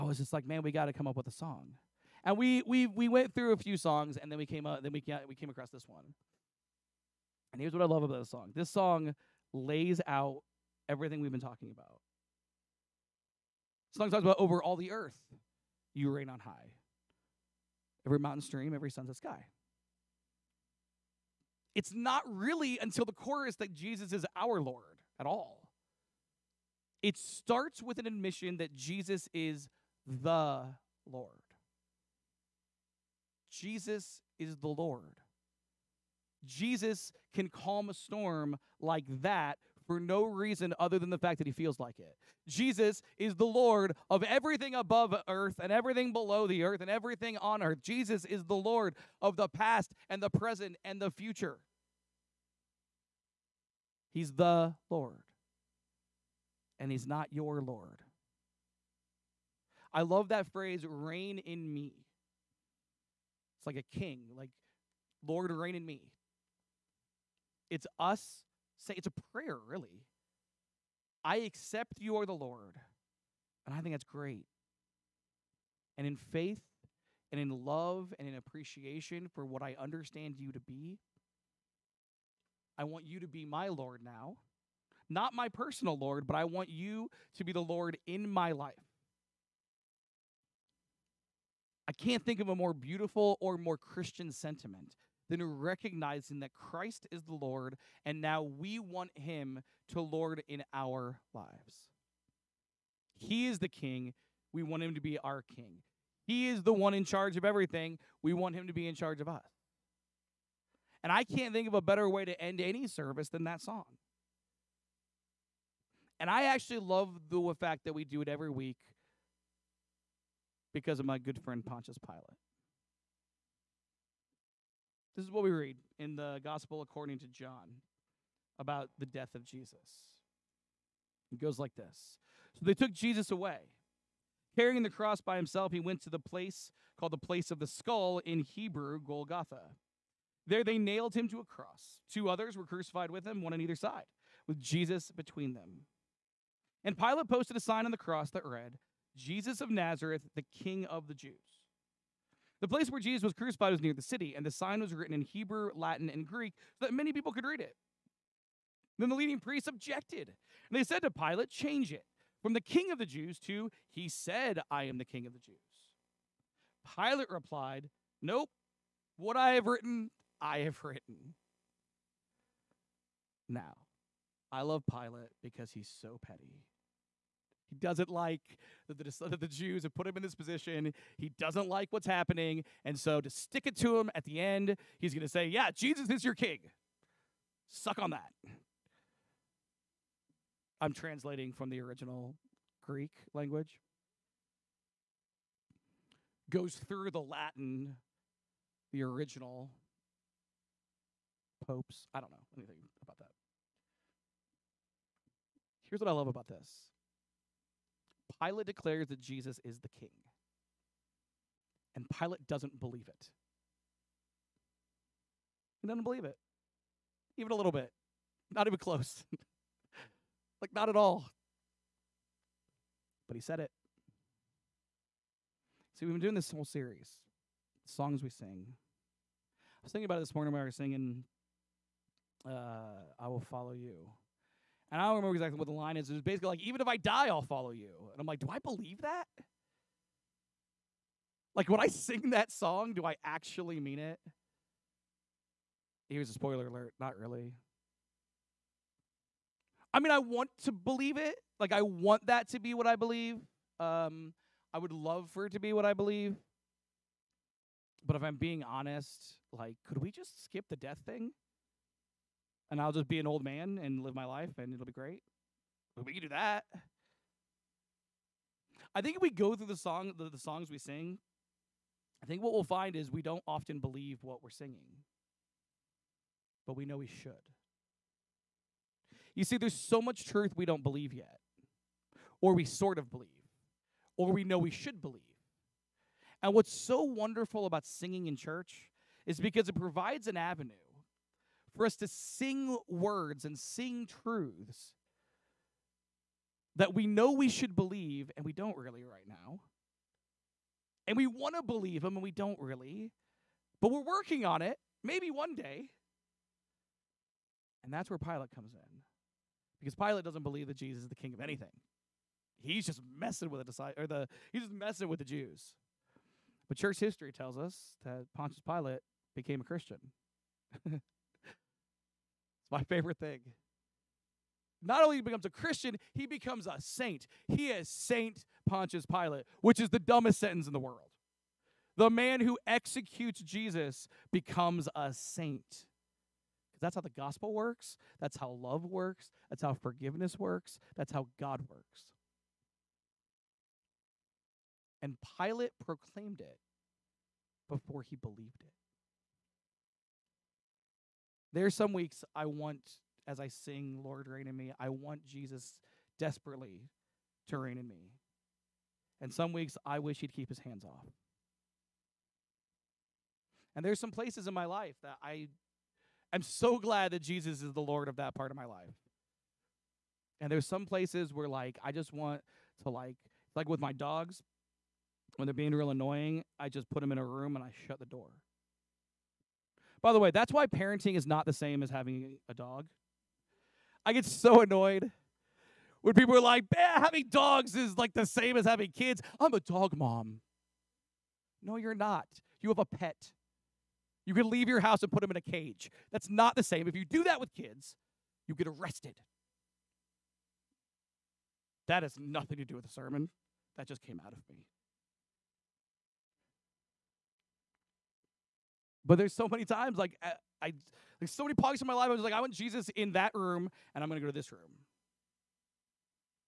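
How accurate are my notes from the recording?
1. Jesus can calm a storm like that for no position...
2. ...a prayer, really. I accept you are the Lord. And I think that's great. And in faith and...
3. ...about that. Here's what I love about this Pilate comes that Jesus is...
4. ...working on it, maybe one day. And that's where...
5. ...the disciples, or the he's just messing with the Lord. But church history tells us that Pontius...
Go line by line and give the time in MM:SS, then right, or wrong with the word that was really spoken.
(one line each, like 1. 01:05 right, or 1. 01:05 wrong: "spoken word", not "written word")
1. 00:36 wrong: "reason", not "position"
2. 01:09 right
3. 03:23 wrong: "declares", not "comes"
4. 05:04 right
5. 05:13 wrong: "Jews", not "Lord".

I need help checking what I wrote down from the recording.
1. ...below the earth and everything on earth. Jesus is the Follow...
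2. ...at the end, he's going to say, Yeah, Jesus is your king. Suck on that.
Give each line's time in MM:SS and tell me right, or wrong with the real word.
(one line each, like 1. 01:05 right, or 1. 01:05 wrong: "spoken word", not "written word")
1. 00:46 wrong: "Lord", not "Follow"
2. 03:04 right.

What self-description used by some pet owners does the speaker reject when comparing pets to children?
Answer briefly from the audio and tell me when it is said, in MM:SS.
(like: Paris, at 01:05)
dog mom, at 06:29.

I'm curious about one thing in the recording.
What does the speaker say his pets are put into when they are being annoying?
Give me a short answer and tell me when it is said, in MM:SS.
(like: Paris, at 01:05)
a room, at 06:17.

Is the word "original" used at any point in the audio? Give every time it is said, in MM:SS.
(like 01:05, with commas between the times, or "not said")
03:11, 03:19.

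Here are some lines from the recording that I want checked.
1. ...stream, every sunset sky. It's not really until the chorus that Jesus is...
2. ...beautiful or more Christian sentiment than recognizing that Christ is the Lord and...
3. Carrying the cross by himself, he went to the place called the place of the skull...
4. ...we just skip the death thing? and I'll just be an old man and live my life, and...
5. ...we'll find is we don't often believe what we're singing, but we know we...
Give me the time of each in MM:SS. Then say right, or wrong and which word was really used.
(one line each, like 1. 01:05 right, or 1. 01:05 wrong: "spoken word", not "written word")
1. 00:18 right
2. 01:32 right
3. 02:14 right
4. 04:19 right
5. 04:32 right.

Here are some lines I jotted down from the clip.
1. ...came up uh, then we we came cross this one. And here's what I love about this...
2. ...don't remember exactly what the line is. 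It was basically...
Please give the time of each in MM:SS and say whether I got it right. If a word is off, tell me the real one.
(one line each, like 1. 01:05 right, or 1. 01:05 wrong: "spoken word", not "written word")
1. 00:04 wrong: "across", not "cross"
2. 03:55 right.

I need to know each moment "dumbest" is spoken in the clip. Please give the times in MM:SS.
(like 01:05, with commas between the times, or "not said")
05:29.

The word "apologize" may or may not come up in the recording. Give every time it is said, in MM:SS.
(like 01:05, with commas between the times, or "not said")
not said.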